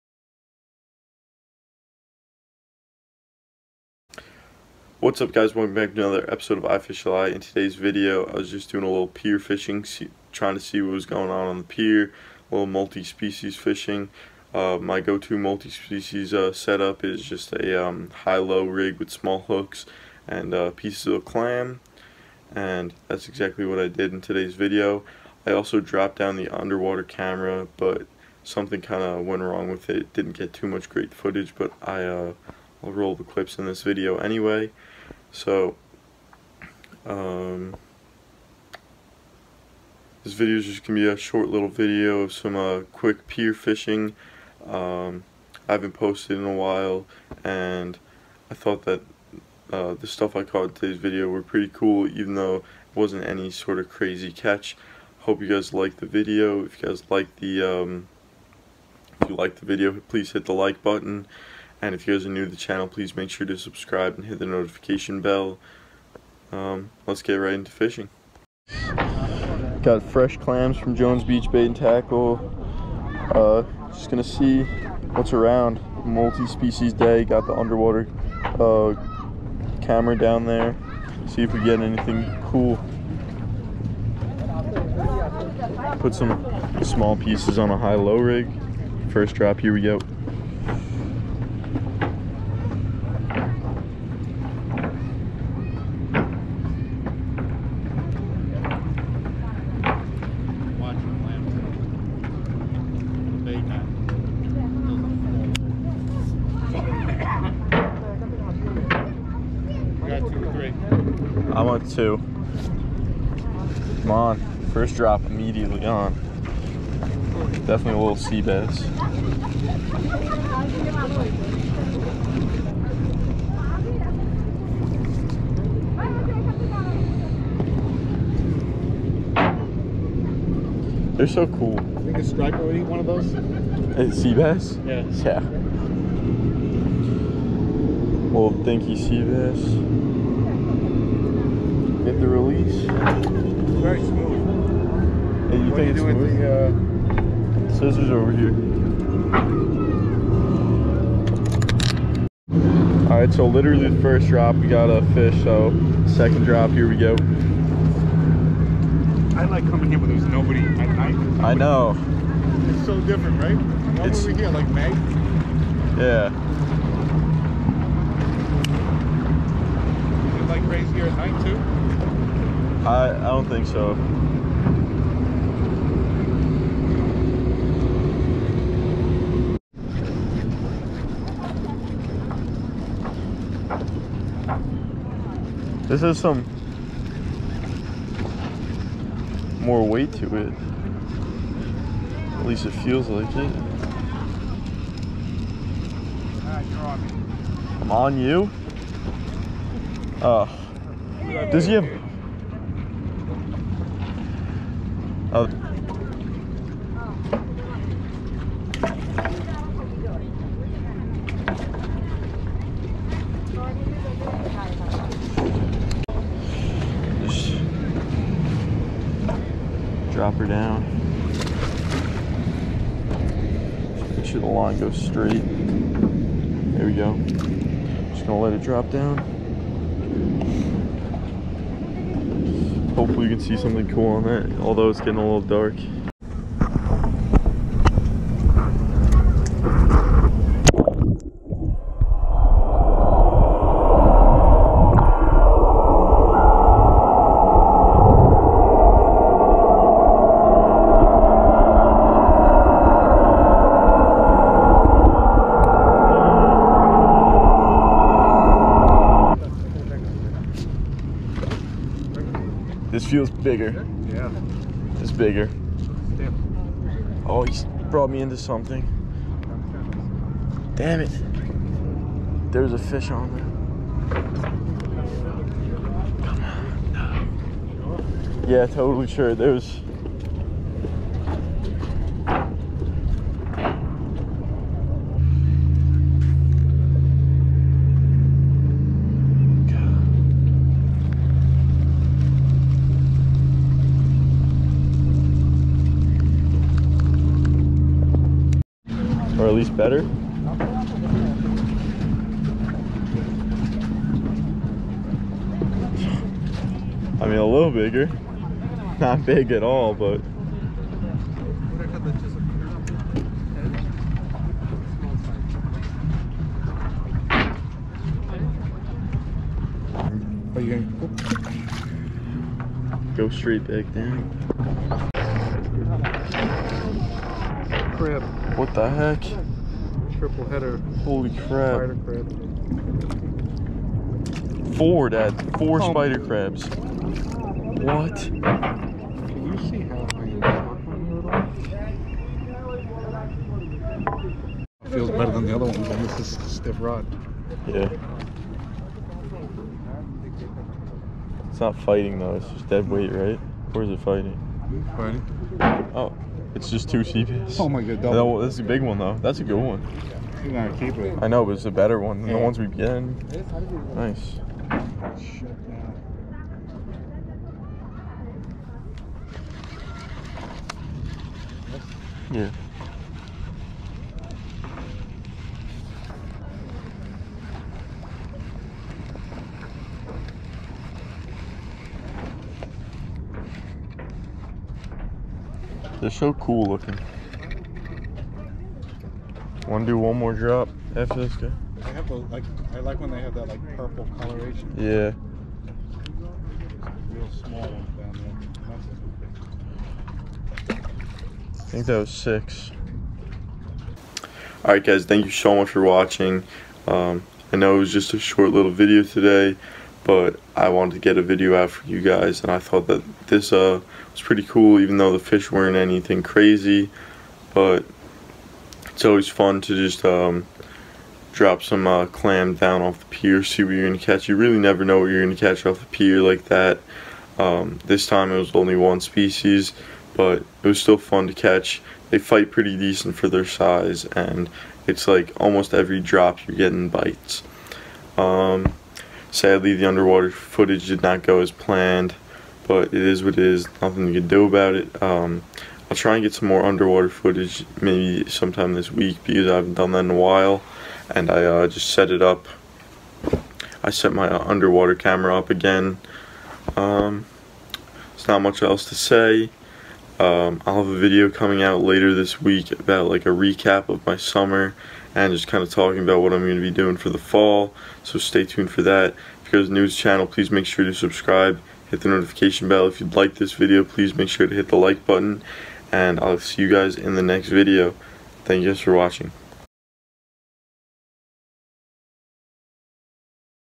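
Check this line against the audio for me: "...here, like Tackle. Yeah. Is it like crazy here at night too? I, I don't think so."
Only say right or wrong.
wrong.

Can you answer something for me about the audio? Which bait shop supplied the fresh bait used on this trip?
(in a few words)
Jones Beach Bait and Tackle.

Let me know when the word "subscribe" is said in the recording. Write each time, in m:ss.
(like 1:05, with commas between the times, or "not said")
1:03, 7:50.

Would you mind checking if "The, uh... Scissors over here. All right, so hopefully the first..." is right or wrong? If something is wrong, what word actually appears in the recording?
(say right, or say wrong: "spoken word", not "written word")
wrong: "literally", not "hopefully".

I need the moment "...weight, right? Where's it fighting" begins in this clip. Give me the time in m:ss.
5:52.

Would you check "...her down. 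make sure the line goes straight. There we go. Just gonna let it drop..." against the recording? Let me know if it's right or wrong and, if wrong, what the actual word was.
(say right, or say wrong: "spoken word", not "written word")
right.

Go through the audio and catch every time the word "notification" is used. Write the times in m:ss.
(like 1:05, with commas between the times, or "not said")
1:04, 7:52.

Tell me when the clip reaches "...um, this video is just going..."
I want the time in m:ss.
0:37.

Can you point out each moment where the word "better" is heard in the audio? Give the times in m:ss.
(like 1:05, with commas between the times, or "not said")
4:59, 5:45, 6:01.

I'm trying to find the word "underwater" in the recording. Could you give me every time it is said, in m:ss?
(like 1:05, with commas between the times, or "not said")
0:26, 1:17, 7:19, 7:26, 7:34.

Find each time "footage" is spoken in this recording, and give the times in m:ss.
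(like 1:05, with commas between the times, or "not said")
0:31, 7:20, 7:27.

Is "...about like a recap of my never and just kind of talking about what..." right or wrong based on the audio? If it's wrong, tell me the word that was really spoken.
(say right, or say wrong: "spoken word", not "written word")
wrong: "summer", not "never".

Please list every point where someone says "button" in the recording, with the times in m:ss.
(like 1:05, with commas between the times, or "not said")
1:00, 7:55.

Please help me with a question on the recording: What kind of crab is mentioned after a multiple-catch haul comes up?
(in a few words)
Spider crab.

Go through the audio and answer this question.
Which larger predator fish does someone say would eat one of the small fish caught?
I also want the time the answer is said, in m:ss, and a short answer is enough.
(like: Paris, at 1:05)
Striper, at 2:12.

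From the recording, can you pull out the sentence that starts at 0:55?
Hope you guys liked the video.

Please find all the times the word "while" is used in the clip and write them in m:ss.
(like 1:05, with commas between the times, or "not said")
0:46, 7:30.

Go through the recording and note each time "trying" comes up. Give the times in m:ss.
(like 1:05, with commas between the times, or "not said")
0:10.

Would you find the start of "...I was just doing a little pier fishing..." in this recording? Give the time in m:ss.
0:08.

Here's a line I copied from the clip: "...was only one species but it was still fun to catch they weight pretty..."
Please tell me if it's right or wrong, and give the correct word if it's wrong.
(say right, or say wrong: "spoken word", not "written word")
wrong: "fight", not "weight".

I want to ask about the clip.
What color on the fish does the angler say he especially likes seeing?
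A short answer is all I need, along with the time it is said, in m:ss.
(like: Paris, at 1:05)
Purple, at 6:33.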